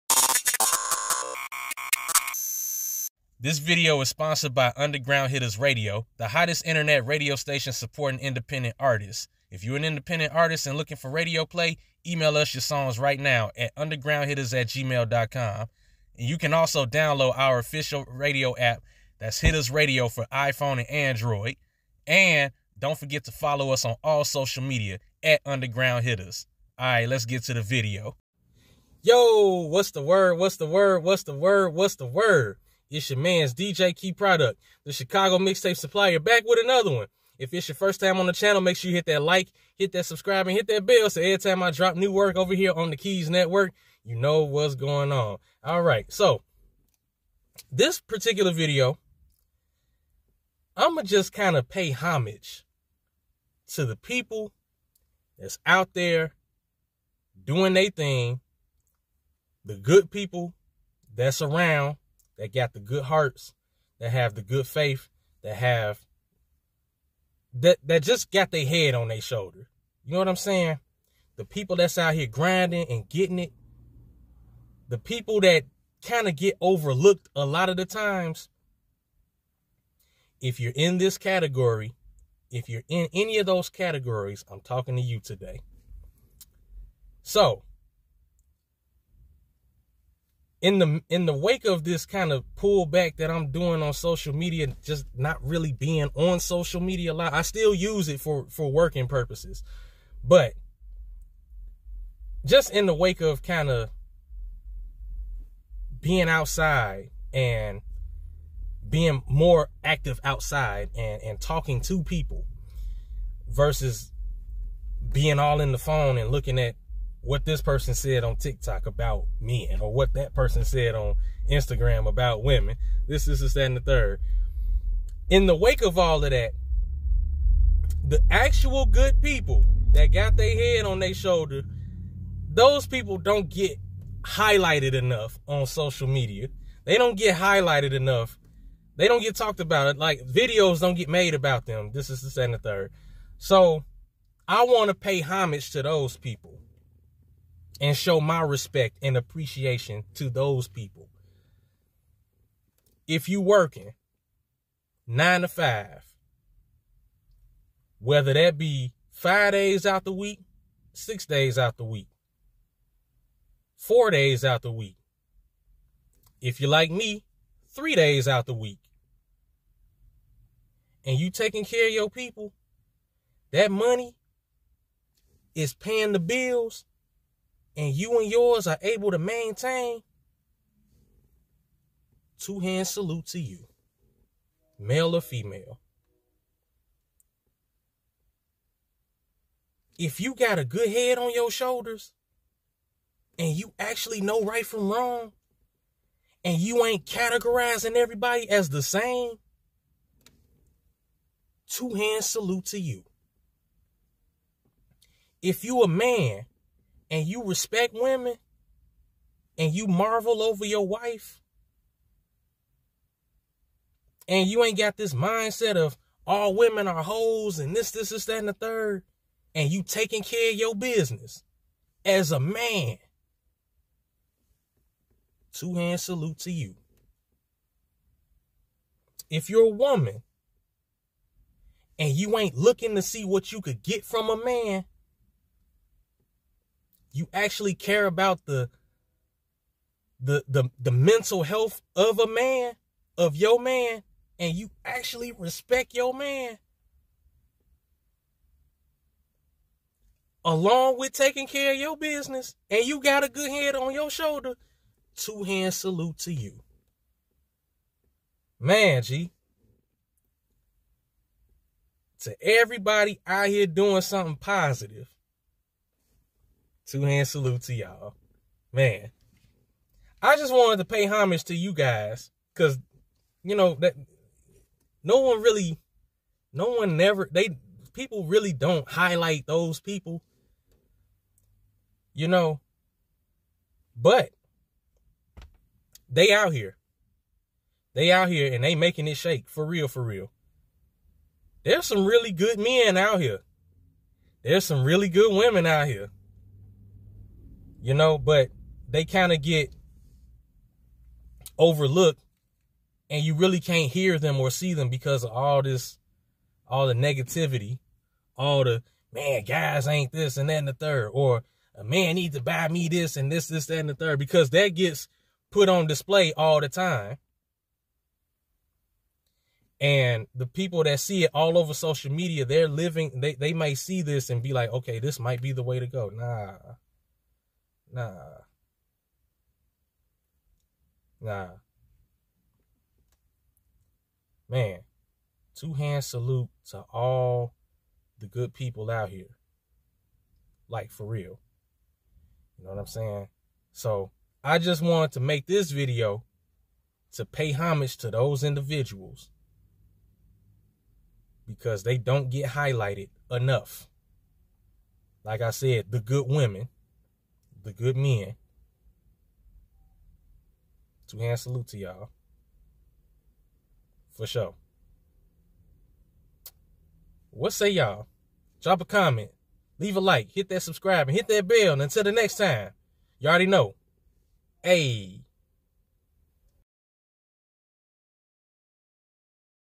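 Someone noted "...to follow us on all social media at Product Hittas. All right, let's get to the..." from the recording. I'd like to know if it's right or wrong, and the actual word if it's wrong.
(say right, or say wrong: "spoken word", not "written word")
wrong: "Underground", not "Product".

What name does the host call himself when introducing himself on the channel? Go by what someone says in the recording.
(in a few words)
DJ Key Product.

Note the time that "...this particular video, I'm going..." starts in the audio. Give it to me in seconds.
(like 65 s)
47 s.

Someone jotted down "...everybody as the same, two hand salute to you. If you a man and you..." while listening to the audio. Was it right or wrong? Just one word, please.
right.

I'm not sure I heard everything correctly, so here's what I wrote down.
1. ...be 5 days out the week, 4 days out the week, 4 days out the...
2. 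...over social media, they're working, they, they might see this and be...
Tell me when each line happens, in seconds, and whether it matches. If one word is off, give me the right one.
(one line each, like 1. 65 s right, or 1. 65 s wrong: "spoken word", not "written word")
1. 158 s wrong: "6", not "4"
2. 321 s wrong: "living", not "working".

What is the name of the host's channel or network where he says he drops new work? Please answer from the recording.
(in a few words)
Keyz Netwerk.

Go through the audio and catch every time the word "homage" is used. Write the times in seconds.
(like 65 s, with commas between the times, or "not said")
51 s, 145 s, 271 s, 347 s.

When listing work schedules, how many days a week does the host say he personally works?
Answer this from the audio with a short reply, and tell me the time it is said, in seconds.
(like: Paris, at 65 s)
3, at 167 s.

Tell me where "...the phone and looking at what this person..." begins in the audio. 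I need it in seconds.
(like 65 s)
115 s.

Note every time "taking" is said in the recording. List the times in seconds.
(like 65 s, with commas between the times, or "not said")
171 s, 219 s, 251 s.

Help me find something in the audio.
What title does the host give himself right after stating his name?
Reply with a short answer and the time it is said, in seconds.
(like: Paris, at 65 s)
Chicago Mixtape Supplier, at 34 s.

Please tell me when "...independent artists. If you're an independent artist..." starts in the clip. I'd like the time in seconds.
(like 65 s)
8 s.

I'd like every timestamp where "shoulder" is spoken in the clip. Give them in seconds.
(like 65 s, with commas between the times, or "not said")
69 s, 131 s, 191 s, 254 s.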